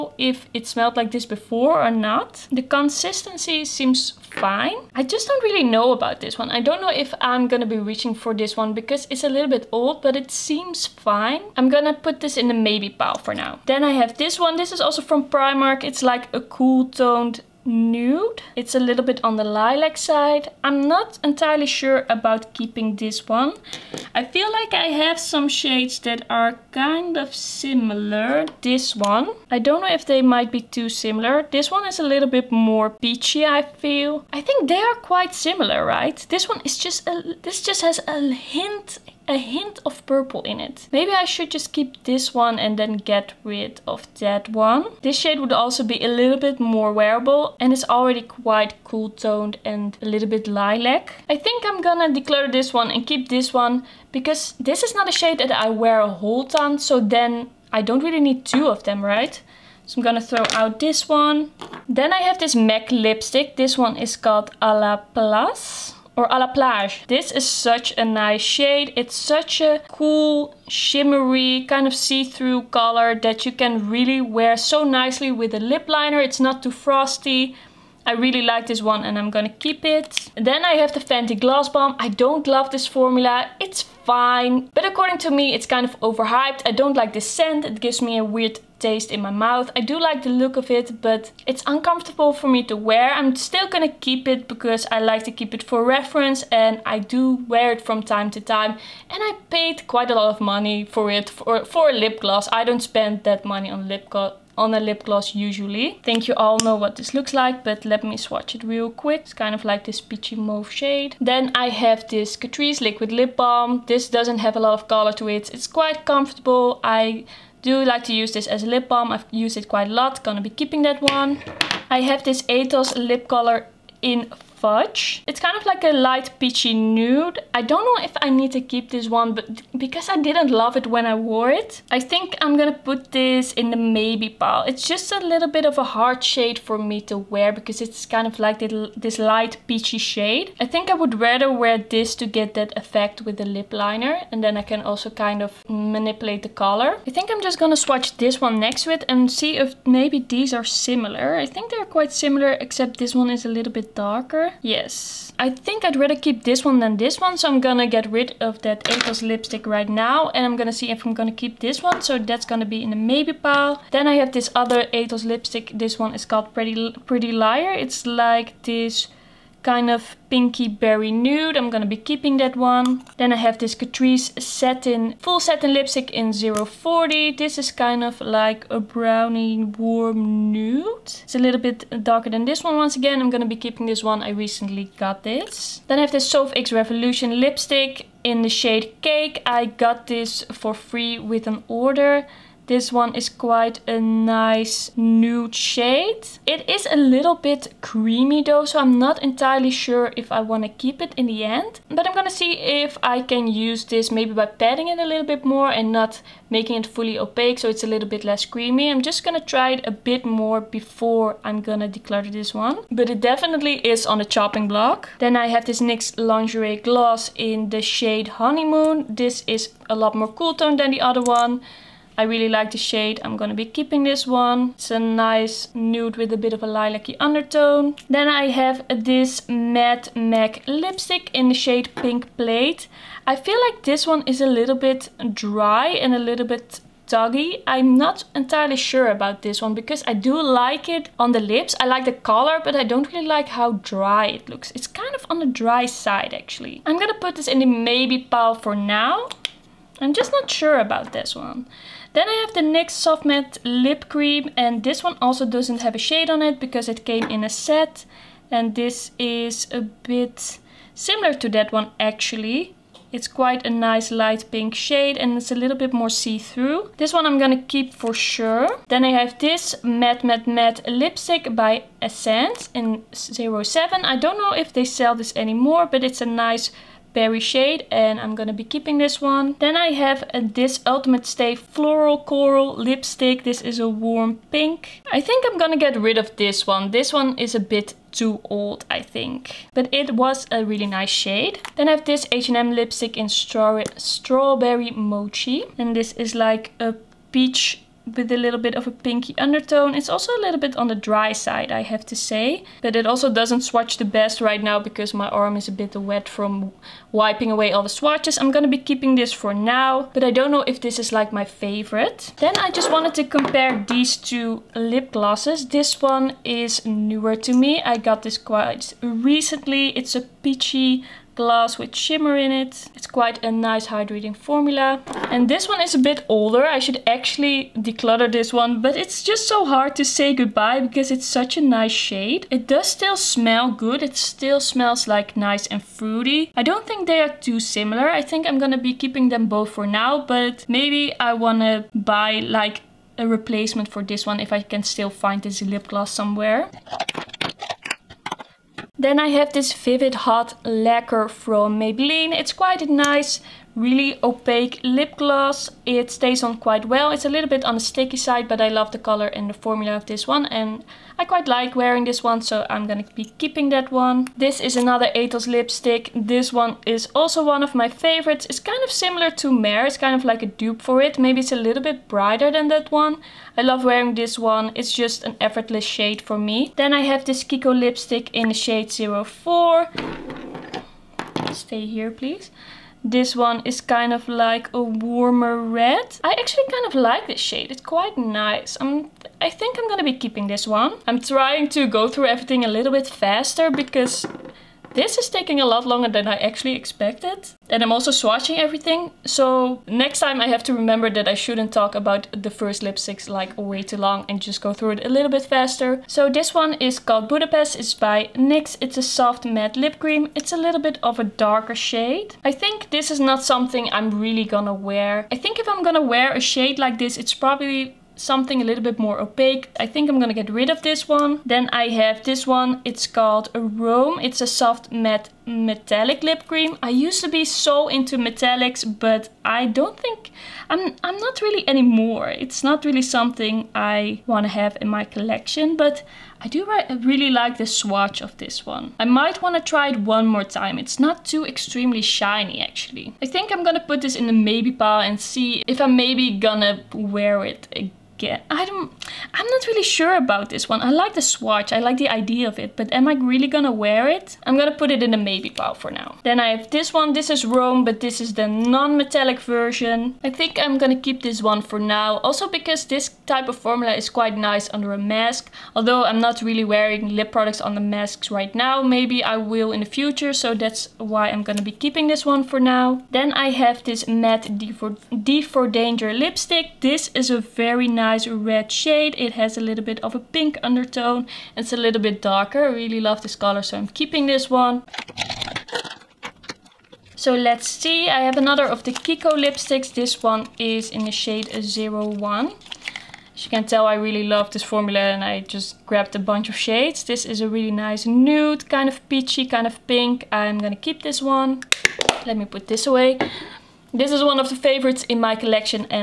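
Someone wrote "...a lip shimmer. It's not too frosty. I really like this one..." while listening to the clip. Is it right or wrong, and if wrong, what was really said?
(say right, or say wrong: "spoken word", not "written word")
wrong: "liner", not "shimmer".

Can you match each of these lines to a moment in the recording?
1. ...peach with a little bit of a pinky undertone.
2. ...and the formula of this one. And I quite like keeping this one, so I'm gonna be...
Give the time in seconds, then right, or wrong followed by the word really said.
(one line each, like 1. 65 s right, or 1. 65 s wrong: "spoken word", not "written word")
1. 297 s right
2. 359 s wrong: "wearing", not "keeping".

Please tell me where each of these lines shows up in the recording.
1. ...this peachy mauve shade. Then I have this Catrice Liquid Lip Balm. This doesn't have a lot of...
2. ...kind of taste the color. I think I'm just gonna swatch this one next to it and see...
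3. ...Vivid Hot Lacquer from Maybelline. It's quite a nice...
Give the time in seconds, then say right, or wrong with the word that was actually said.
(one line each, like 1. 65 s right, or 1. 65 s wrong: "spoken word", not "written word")
1. 109 s right
2. 145 s wrong: "manipulate", not "taste"
3. 349 s right.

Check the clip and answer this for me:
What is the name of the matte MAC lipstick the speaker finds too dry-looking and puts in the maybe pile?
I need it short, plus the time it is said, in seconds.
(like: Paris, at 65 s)
Pink Plaid, at 231 s.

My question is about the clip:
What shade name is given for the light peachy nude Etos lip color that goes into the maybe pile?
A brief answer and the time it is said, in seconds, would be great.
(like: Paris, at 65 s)
Fudge, at 124 s.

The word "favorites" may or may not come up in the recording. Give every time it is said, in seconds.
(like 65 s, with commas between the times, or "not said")
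311 s, 367 s, 504 s.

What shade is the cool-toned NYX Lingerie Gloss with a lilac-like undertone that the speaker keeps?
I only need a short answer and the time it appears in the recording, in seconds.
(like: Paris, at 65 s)
Honeymoon, at 218 s.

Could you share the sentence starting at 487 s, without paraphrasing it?
So let's see, I have another of the Kiko lipsticks.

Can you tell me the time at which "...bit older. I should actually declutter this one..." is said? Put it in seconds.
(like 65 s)
326 s.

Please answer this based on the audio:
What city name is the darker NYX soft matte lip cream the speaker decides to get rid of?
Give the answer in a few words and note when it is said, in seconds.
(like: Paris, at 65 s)
Budapest, at 407 s.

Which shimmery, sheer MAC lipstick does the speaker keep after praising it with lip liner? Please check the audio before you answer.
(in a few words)
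A La Place.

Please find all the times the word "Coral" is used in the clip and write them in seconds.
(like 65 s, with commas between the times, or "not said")
282 s.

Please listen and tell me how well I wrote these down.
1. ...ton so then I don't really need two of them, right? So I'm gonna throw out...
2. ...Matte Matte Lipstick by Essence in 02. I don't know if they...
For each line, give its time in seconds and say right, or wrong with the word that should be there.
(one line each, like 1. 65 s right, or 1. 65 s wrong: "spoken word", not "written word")
1. 56 s right
2. 270 s wrong: "07", not "02".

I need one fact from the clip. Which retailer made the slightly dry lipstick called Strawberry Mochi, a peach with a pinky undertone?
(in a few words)
H&M.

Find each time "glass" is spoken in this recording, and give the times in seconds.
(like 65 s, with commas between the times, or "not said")
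321 s.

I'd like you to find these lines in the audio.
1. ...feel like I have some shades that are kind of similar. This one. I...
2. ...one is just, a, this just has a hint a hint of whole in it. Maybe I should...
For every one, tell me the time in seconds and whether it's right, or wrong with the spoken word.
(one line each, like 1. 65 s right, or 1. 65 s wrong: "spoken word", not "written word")
1. 24 s right
2. 36 s wrong: "purple", not "whole".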